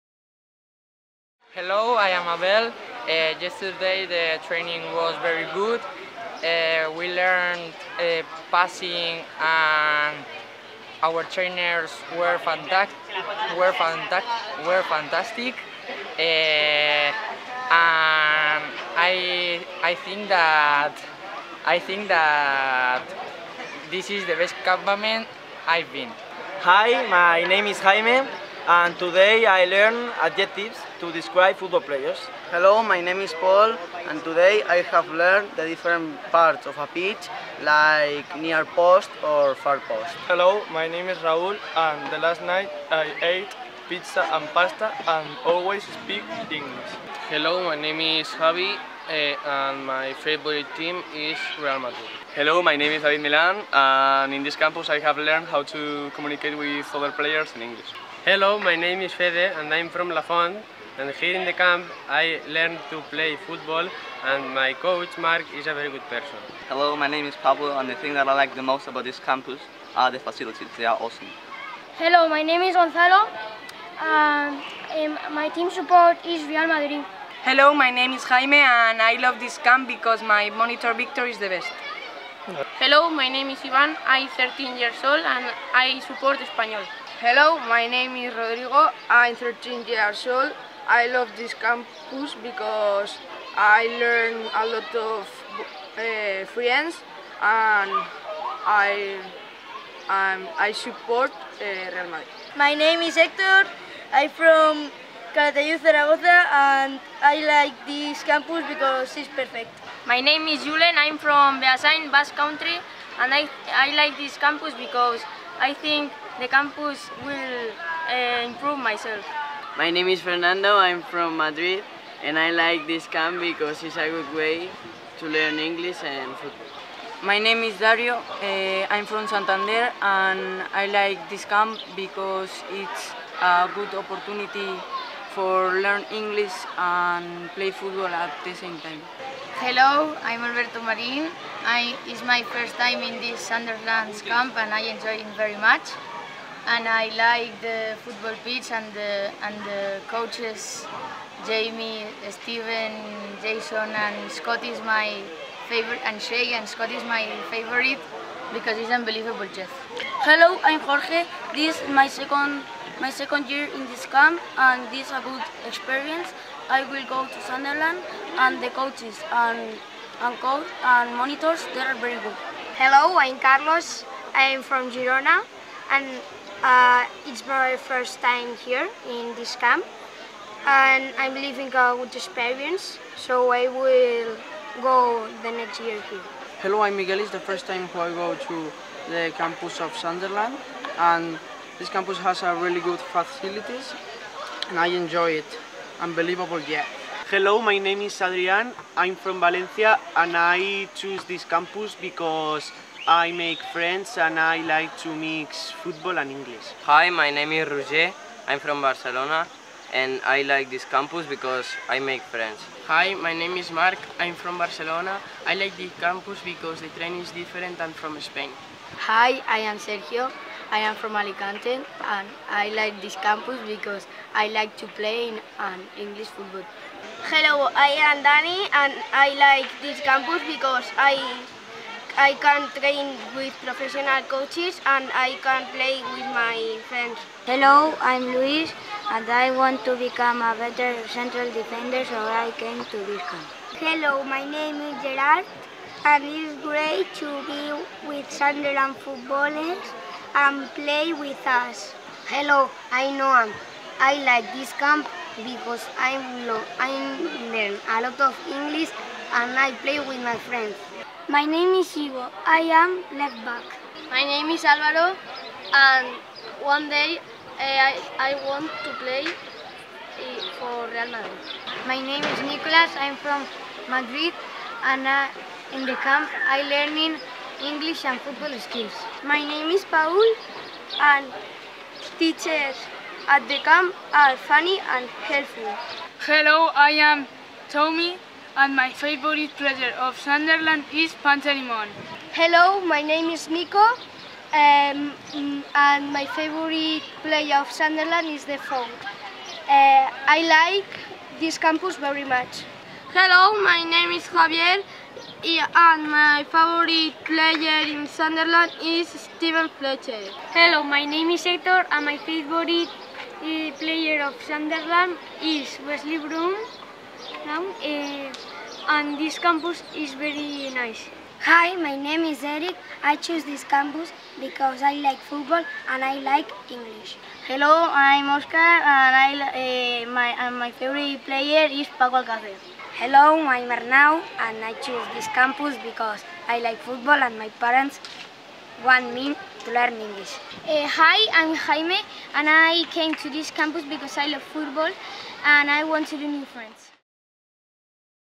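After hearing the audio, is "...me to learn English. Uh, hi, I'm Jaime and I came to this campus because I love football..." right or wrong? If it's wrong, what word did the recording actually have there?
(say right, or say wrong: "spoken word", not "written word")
right.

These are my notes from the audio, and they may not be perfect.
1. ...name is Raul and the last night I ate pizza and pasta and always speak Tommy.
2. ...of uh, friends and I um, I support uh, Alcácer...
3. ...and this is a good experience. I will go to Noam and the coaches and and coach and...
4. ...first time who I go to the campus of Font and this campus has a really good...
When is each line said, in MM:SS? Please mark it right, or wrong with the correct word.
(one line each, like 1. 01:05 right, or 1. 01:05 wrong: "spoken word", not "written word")
1. 00:40 wrong: "English", not "Tommy"
2. 01:34 wrong: "Real", not "Alcácer"
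3. 02:44 wrong: "Sunderland", not "Noam"
4. 03:07 wrong: "Sunderland", not "Font".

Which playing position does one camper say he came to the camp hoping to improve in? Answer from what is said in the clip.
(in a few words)
Central defender.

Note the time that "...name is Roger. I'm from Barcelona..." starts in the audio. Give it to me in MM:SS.
03:27.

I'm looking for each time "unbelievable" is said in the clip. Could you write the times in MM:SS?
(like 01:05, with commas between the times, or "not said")
02:38, 03:15.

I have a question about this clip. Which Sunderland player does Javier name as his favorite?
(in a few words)
Steven Fletcher.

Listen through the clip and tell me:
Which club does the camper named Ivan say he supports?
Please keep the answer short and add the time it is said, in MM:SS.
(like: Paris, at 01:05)
Espanyol, at 01:26.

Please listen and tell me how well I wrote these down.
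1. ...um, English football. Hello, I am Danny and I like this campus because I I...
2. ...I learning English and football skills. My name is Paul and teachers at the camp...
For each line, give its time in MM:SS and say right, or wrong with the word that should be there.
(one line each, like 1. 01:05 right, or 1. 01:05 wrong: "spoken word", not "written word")
1. 03:45 right
2. 04:36 right.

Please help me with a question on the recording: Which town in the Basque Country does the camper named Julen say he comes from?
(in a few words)
Beasain.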